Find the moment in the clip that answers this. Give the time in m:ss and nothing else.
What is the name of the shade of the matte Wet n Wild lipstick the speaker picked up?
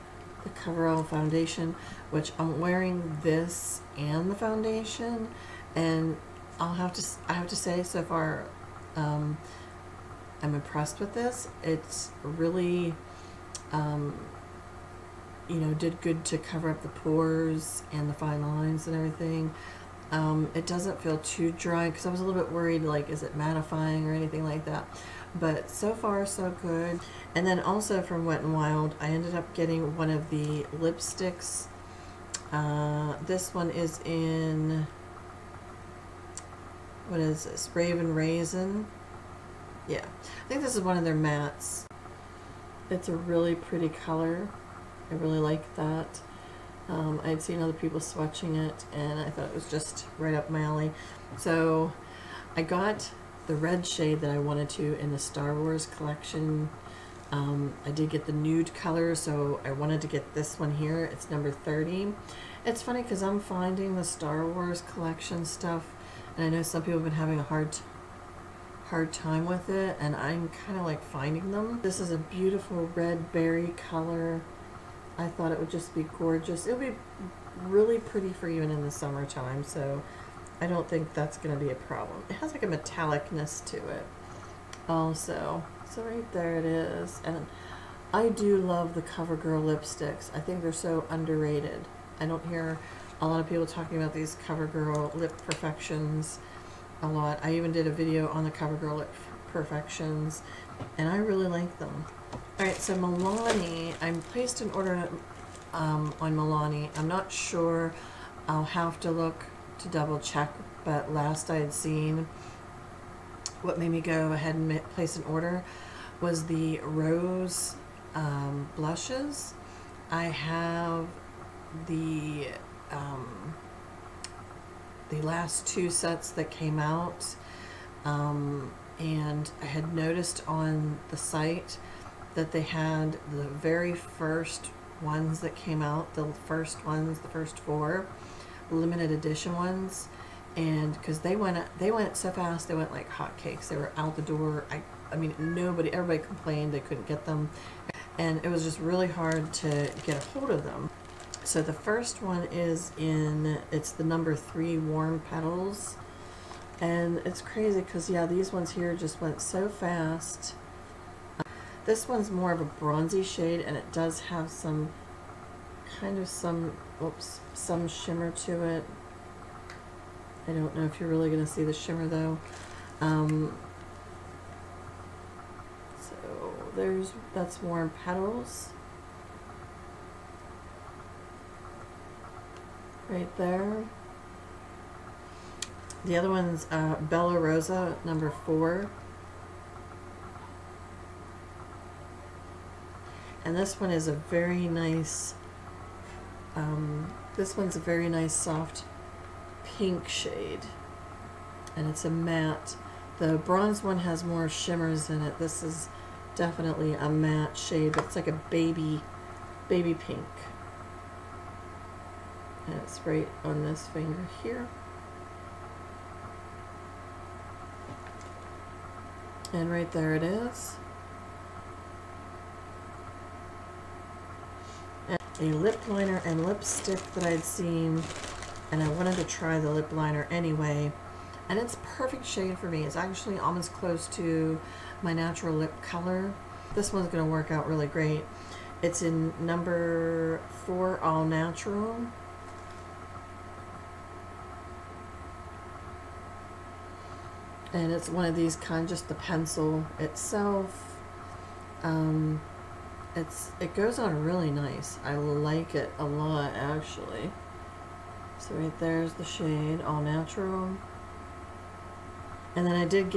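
0:37.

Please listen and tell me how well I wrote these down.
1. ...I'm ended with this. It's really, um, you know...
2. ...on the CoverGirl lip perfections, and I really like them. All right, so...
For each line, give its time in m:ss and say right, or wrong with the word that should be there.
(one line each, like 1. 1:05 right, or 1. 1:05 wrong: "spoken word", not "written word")
1. 0:10 wrong: "impressed", not "ended"
2. 1:38 right.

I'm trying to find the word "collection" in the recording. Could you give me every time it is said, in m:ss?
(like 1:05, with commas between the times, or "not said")
0:55, 1:04.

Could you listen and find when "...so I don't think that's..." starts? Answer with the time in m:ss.
1:19.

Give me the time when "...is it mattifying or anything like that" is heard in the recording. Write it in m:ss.
0:23.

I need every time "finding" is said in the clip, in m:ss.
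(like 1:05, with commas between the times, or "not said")
1:03, 1:11.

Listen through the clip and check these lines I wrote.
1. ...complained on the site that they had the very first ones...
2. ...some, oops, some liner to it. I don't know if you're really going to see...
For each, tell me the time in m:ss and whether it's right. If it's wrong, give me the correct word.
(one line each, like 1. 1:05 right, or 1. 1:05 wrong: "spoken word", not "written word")
1. 2:09 wrong: "noticed", not "complained"
2. 2:46 wrong: "shimmer", not "liner".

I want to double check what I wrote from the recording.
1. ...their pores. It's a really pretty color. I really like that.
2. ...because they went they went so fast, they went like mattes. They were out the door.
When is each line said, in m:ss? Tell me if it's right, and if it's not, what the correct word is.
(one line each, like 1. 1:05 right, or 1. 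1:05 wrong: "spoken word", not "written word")
1. 0:41 wrong: "mattes", not "pores"
2. 2:20 wrong: "hotcakes", not "mattes".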